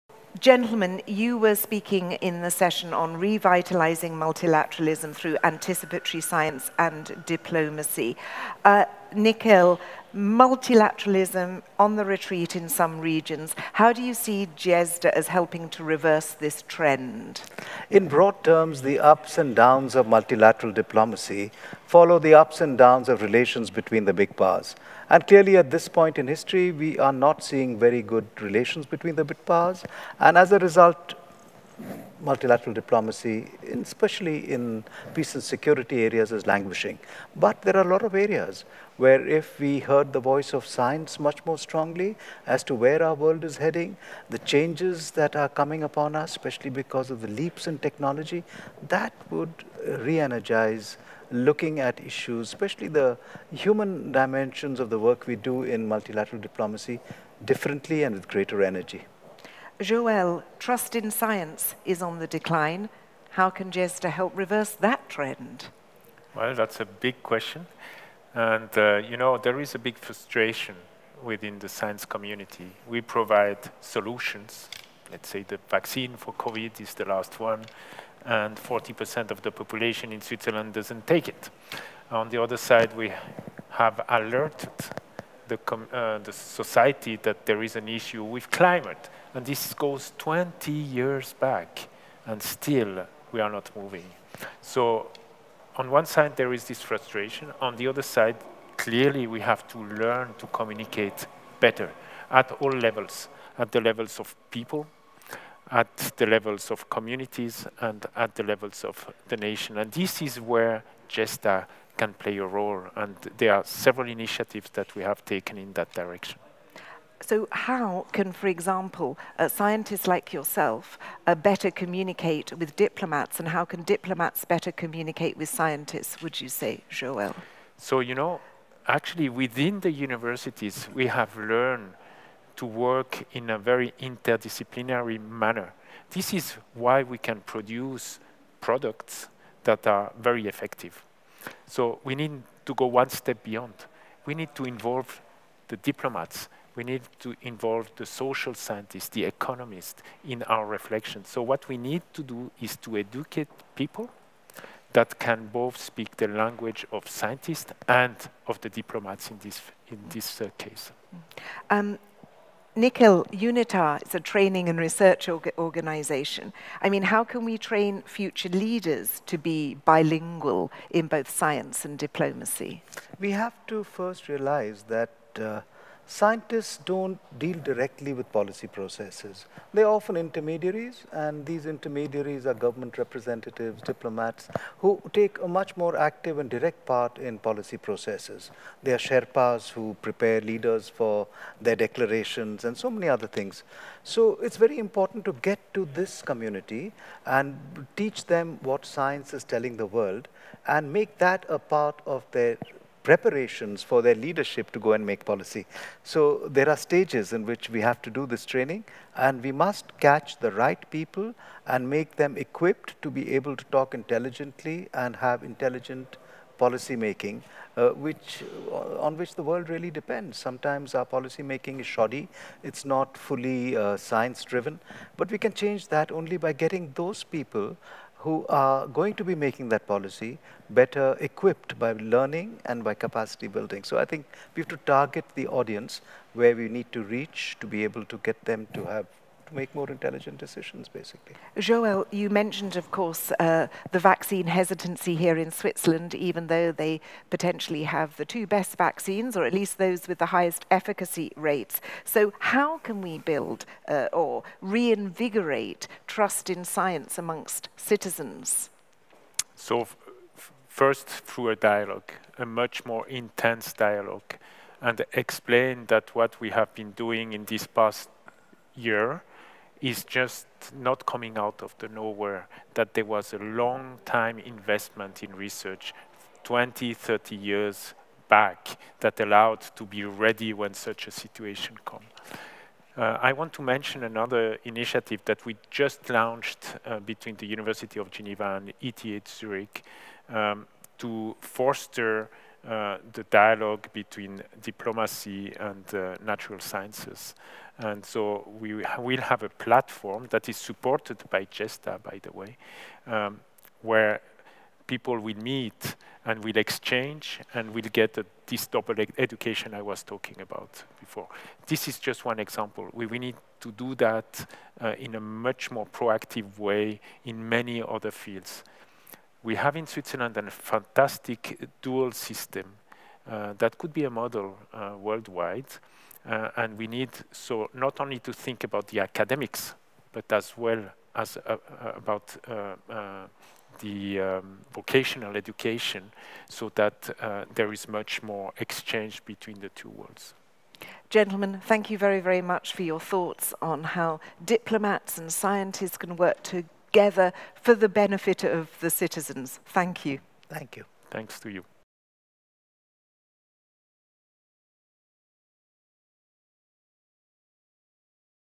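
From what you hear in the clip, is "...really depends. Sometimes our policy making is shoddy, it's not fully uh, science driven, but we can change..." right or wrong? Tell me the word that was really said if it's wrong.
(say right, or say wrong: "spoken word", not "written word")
right.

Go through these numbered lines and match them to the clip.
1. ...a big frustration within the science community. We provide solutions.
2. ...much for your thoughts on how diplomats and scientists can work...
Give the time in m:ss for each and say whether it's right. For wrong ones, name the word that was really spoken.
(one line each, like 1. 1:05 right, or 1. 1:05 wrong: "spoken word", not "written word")
1. 1:09 right
2. 5:42 right.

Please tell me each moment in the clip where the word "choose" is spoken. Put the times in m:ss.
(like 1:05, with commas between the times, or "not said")
not said.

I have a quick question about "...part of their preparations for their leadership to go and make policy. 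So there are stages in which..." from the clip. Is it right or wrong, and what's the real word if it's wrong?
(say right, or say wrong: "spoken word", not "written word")
right.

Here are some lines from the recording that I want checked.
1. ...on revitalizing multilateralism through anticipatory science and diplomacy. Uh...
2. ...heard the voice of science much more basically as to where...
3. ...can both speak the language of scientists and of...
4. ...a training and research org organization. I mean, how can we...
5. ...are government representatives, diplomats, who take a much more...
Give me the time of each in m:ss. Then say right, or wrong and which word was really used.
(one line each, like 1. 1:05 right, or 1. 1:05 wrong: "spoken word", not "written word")
1. 0:02 right
2. 0:39 wrong: "strongly", not "basically"
3. 2:35 right
4. 2:44 right
5. 3:02 right.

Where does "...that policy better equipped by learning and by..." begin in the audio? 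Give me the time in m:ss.
3:49.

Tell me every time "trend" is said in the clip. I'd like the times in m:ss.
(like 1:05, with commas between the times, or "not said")
0:16, 1:05.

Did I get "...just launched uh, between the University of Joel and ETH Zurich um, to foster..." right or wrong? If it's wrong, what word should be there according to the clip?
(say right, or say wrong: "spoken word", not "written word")
wrong: "Geneva", not "Joel".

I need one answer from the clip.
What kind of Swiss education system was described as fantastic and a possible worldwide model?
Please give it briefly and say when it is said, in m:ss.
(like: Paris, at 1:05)
dual system, at 5:21.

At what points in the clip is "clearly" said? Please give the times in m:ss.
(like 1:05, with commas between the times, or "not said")
0:25, 1:38.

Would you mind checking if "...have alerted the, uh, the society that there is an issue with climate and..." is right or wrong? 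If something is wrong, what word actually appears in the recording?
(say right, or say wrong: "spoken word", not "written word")
right.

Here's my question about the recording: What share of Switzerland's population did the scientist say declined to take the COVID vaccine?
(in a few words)
40%.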